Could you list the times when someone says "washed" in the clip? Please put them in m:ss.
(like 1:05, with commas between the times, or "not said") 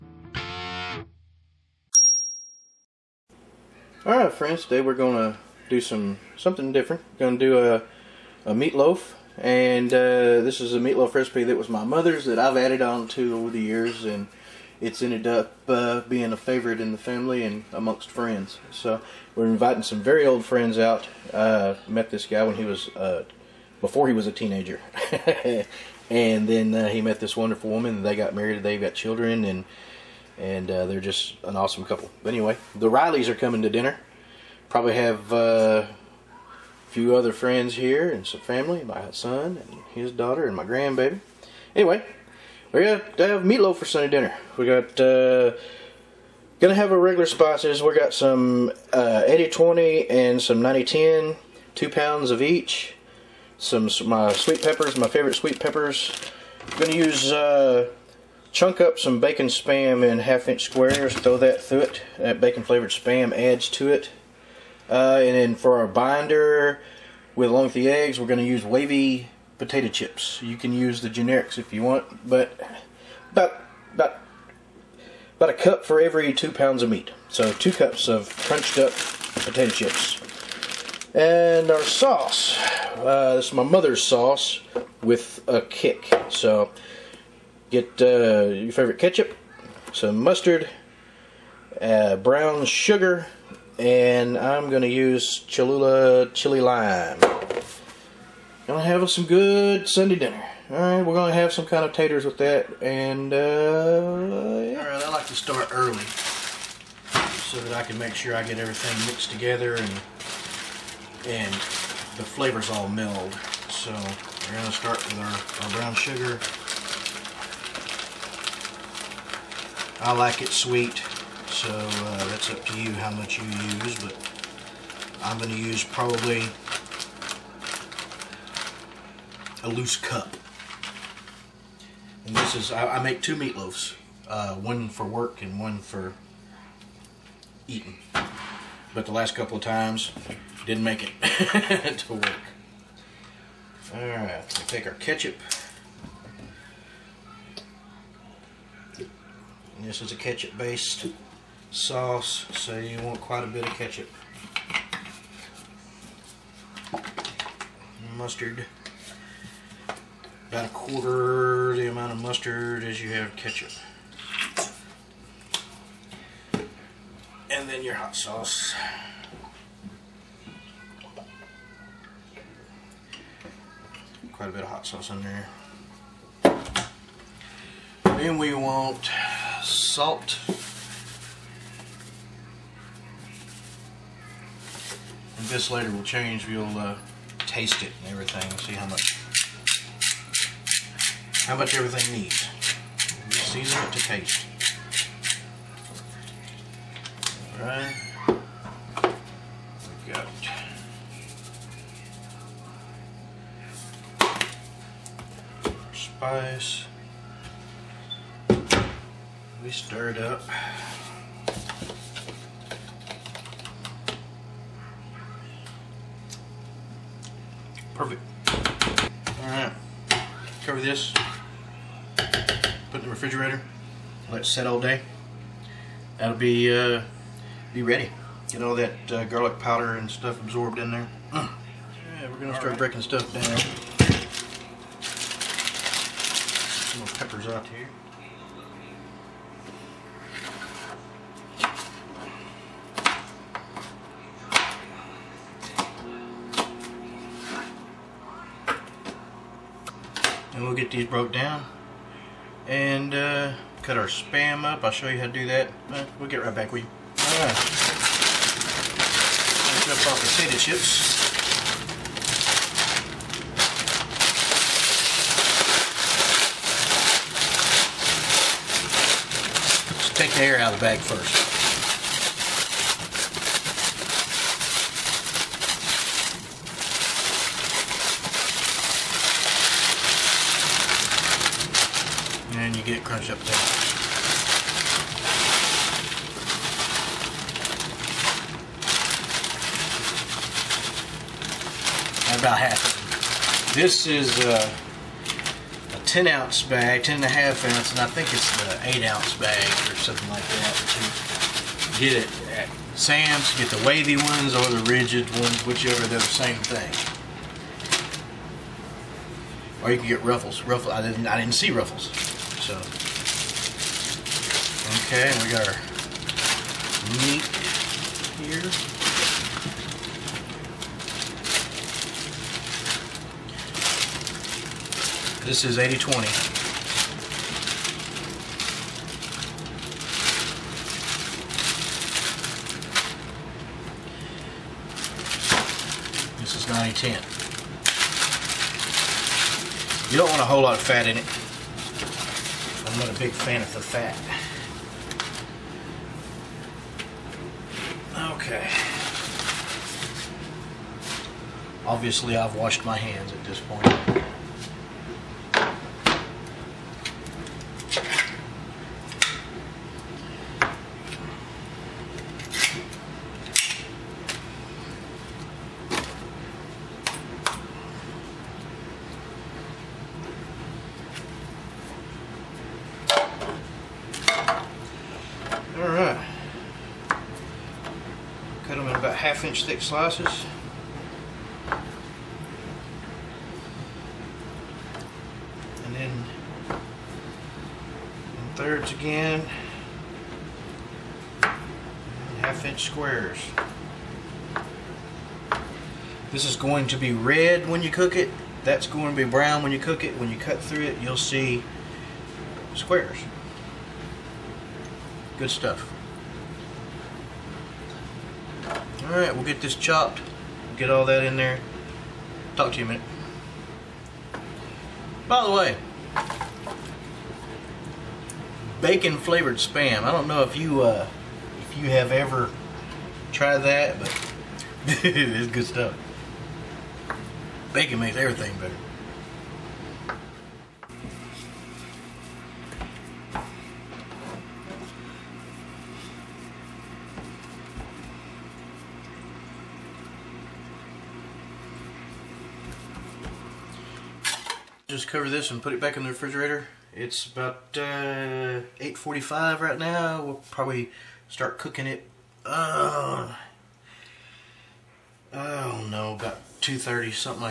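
5:52.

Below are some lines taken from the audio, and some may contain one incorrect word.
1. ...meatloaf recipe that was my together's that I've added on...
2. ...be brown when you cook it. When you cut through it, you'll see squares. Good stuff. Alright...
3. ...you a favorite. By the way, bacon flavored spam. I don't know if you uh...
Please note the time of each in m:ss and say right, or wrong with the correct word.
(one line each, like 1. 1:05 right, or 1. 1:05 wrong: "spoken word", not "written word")
1. 0:10 wrong: "mother", not "together"
2. 6:39 right
3. 6:52 wrong: "minute", not "favorite".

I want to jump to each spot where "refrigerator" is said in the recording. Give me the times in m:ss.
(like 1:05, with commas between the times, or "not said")
3:43, 7:26.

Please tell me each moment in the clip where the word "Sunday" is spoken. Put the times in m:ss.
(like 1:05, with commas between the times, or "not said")
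0:43, 1:39.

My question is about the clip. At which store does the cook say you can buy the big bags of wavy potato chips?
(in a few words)
Sam's.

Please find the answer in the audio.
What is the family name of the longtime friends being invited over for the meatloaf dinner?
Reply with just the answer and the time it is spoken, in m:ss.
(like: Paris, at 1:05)
the Rileys, at 0:32.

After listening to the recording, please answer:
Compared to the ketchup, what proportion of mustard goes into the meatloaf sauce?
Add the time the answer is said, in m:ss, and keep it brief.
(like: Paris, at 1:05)
a quarter, at 2:40.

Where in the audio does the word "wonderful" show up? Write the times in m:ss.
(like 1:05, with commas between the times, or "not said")
0:27.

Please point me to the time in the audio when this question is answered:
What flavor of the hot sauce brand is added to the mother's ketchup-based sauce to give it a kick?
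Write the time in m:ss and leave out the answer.
1:35.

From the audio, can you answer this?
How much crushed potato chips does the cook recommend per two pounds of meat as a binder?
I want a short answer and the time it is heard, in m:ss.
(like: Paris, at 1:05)
about a cup, at 1:15.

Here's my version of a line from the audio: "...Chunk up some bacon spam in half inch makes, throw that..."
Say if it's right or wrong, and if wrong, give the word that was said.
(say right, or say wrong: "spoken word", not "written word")
wrong: "squares", not "makes".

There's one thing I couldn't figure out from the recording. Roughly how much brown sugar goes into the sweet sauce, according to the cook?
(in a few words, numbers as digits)
a loose cup.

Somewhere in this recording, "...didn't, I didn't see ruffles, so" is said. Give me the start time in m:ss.
5:11.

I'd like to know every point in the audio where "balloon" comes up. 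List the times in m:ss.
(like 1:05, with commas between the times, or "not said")
not said.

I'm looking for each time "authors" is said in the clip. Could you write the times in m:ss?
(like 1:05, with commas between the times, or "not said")
not said.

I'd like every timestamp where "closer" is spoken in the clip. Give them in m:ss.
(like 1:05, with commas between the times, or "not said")
not said.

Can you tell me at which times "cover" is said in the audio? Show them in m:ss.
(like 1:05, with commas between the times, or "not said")
3:40, 7:25.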